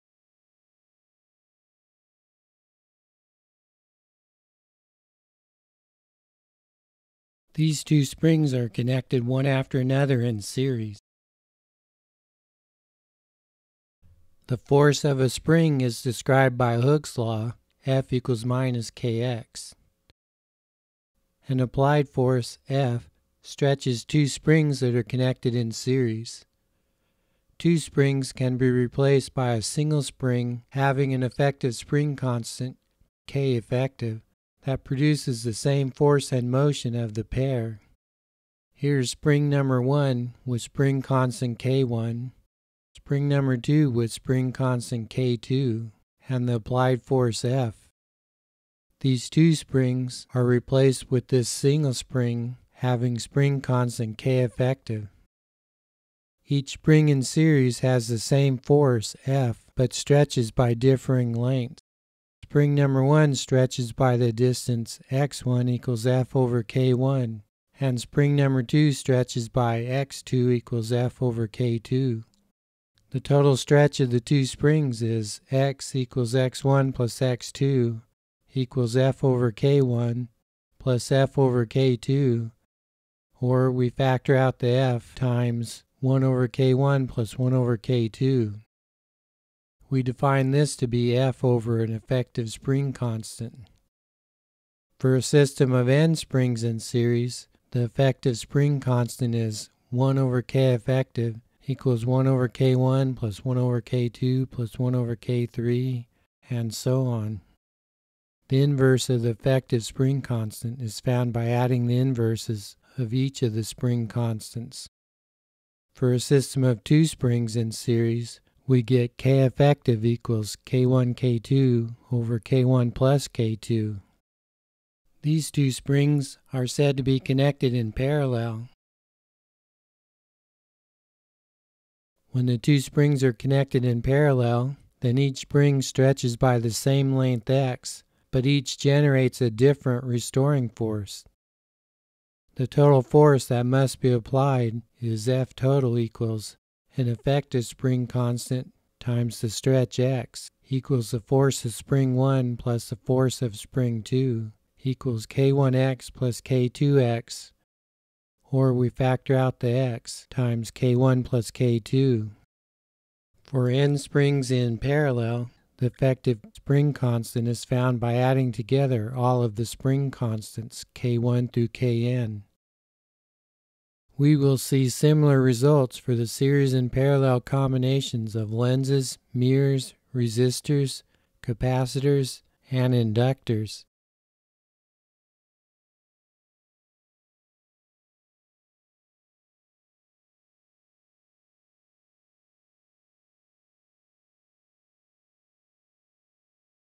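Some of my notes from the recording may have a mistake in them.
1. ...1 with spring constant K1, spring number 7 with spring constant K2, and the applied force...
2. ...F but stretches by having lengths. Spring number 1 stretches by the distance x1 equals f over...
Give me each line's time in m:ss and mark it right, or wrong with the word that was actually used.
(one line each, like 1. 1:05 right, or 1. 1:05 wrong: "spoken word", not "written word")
1. 0:39 wrong: "2", not "7"
2. 0:59 wrong: "differing", not "having".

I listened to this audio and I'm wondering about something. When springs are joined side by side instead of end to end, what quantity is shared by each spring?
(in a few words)
the same length x.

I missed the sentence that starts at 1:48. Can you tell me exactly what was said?
The inverse of the effective spring constant is found by adding the inverses of each of the spring constants.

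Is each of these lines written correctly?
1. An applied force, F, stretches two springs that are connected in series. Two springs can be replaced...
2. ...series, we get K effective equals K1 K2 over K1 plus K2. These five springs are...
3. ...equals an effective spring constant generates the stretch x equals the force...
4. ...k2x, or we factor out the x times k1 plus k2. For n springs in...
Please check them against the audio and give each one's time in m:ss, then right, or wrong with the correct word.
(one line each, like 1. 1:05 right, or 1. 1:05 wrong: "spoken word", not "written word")
1. 0:21 right
2. 1:57 wrong: "two", not "five"
3. 2:25 wrong: "times", not "generates"
4. 2:36 right.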